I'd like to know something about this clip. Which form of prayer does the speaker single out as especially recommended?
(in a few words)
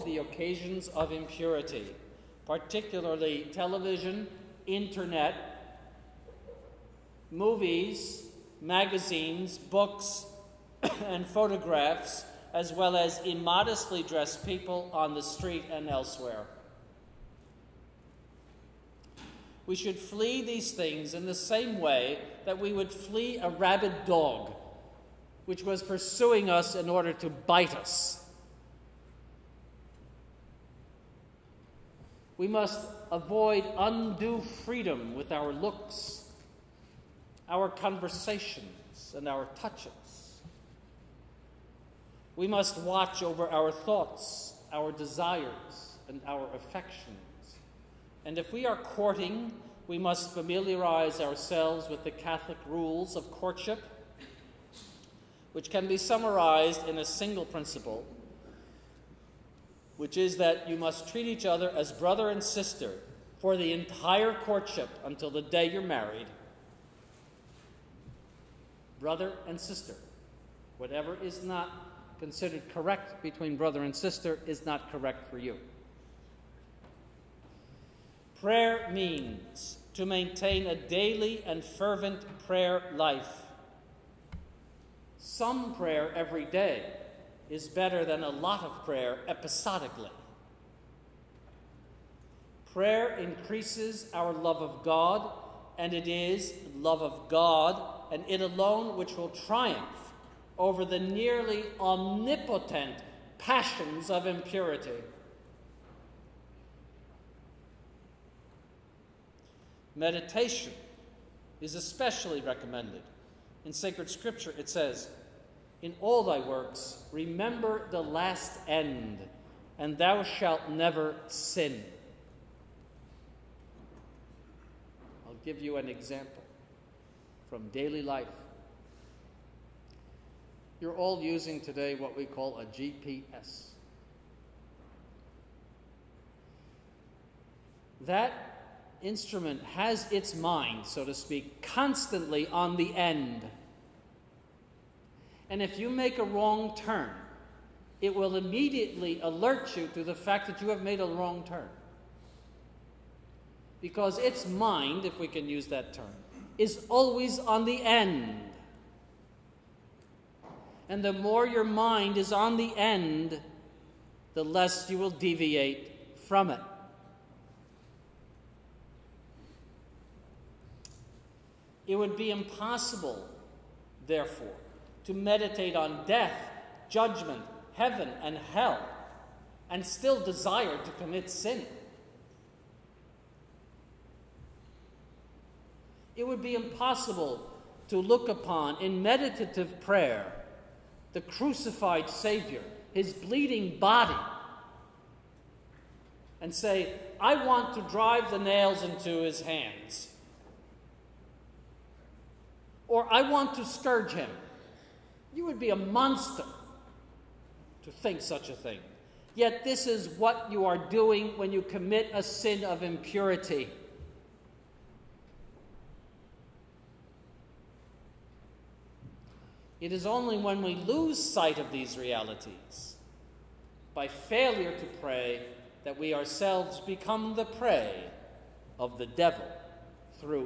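Meditation.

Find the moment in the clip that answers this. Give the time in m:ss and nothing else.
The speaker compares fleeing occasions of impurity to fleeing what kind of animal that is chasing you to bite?
0:23.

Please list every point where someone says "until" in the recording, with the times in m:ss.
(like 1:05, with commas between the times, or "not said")
1:05.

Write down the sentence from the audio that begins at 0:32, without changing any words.
We must avoid undue freedom with our looks our conversations and our touches.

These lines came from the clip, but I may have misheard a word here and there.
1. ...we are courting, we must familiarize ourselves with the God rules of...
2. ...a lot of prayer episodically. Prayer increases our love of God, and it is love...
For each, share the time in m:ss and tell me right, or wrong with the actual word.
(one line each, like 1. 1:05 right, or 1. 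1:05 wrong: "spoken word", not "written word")
1. 0:48 wrong: "Catholic", not "God"
2. 1:28 right.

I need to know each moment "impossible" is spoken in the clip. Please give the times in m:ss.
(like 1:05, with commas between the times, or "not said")
2:52, 3:06.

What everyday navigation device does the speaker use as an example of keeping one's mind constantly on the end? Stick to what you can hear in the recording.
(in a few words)
GPS.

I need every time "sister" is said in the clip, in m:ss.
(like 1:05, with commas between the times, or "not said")
1:02, 1:09, 1:13.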